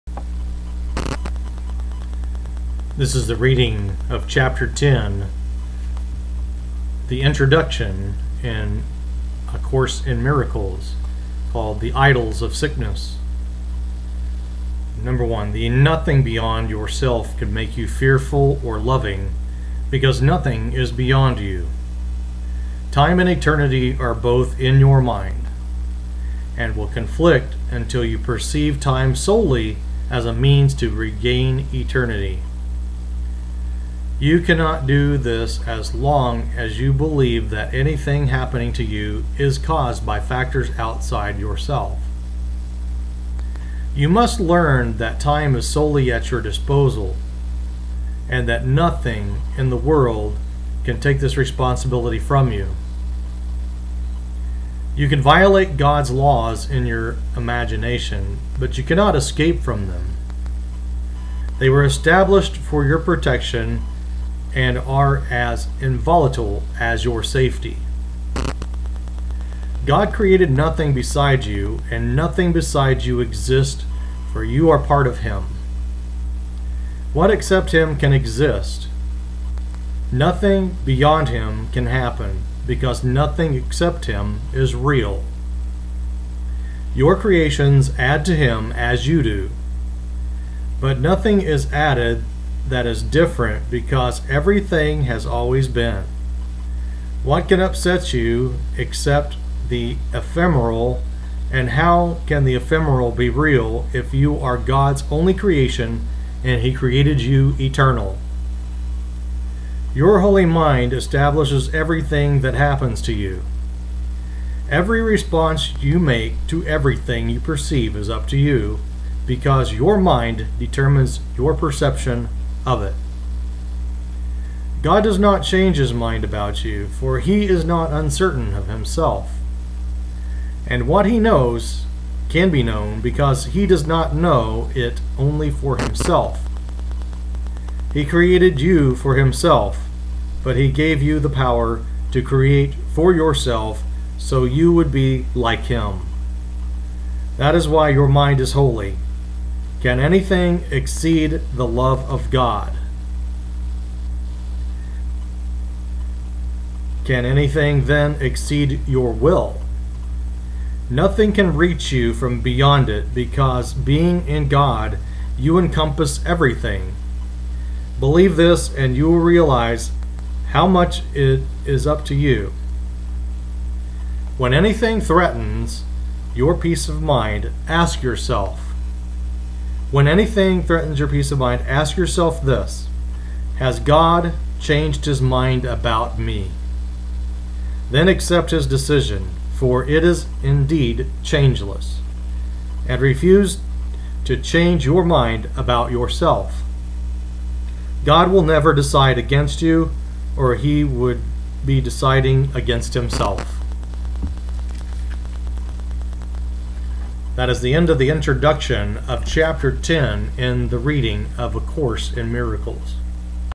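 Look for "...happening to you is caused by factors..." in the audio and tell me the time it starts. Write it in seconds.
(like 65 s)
38 s.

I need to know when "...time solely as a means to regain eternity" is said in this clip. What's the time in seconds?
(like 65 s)
28 s.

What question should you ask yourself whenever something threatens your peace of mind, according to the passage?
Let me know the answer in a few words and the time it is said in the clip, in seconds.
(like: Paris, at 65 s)
Has God changed his mind about me?, at 183 s.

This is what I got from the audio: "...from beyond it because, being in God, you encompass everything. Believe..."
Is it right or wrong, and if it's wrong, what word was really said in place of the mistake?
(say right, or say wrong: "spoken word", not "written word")
right.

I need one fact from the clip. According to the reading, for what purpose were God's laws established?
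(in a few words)
your protection.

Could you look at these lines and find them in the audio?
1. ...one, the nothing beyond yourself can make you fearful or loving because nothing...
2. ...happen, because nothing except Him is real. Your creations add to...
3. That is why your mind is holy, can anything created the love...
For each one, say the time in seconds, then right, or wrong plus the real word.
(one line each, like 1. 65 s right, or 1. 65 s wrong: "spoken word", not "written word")
1. 15 s right
2. 81 s right
3. 147 s wrong: "exceed", not "created".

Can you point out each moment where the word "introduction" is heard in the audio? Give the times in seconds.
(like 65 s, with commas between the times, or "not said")
7 s, 208 s.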